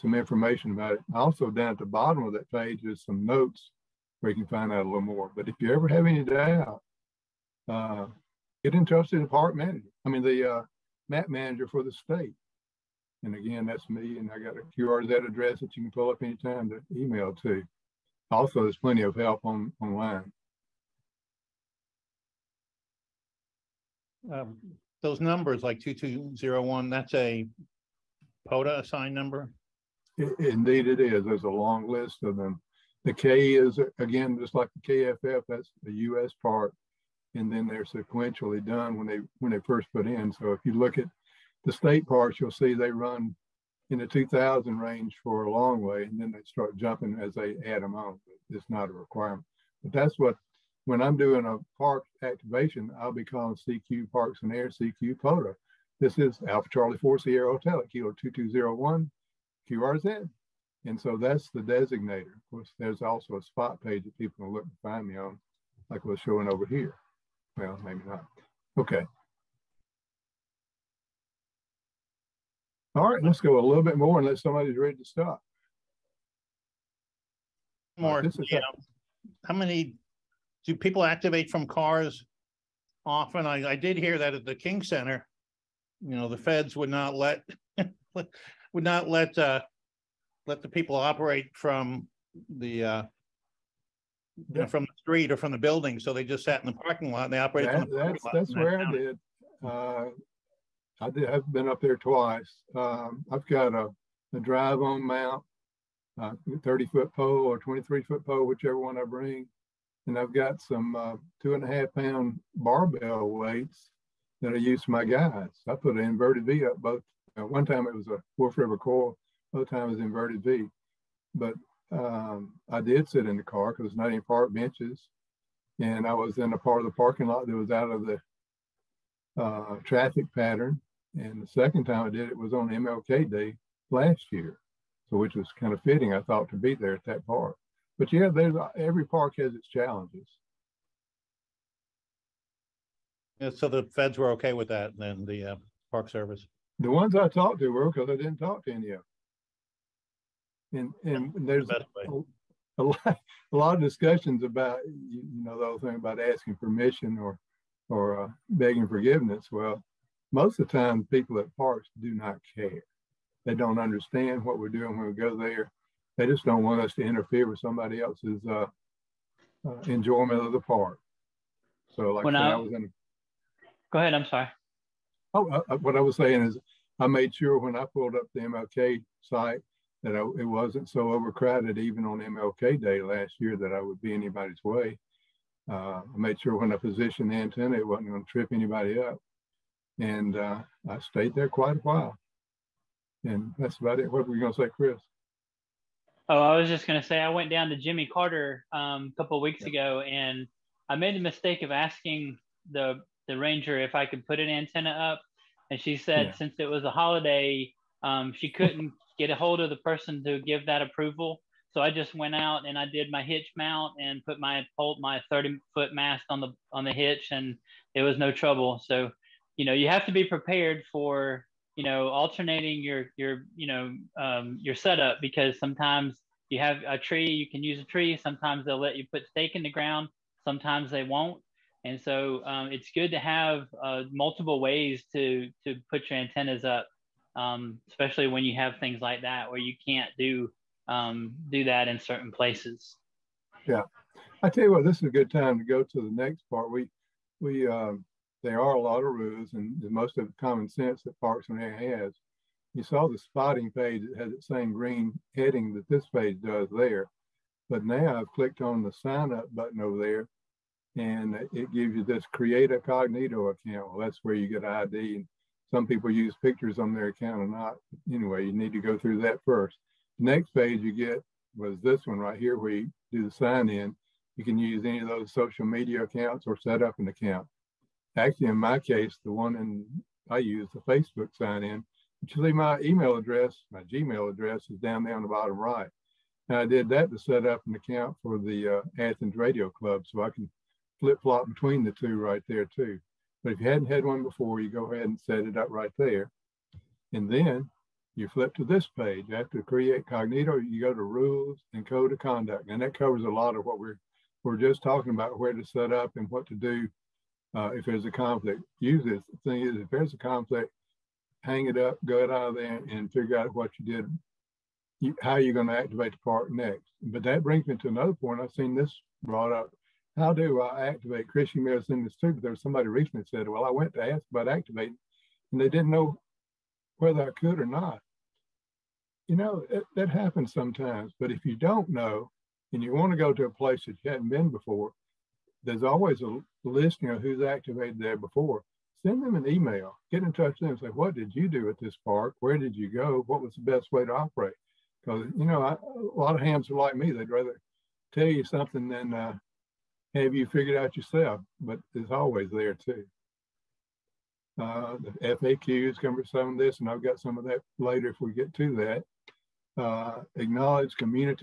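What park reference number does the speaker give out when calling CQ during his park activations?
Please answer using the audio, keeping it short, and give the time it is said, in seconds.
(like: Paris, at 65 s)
K-2201, at 57 s.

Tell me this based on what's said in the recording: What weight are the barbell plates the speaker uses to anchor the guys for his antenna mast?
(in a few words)
2.5 pounds.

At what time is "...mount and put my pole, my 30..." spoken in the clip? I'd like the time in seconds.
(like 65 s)
213 s.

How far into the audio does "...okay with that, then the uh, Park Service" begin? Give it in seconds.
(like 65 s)
144 s.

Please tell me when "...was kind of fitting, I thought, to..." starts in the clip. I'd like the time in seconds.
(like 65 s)
135 s.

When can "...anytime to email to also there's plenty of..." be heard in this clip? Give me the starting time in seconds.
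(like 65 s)
16 s.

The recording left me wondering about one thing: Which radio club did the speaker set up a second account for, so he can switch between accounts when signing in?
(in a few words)
Athens Radio Club.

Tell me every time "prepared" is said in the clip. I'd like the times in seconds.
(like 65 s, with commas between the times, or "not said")
220 s.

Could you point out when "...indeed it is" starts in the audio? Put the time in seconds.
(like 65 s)
30 s.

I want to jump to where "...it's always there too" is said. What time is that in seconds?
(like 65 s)
351 s.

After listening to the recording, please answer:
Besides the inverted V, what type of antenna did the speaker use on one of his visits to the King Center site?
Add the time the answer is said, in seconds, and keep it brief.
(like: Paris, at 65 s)
Wolf River coil, at 118 s.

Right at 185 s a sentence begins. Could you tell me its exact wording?
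Uh, I made sure when I positioned the antenna, it wasn't going to trip anybody up.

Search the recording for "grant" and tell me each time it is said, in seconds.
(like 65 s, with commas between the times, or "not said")
not said.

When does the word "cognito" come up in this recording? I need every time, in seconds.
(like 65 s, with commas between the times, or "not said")
262 s, 300 s.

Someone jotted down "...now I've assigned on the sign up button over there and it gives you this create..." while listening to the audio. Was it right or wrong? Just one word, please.
wrong.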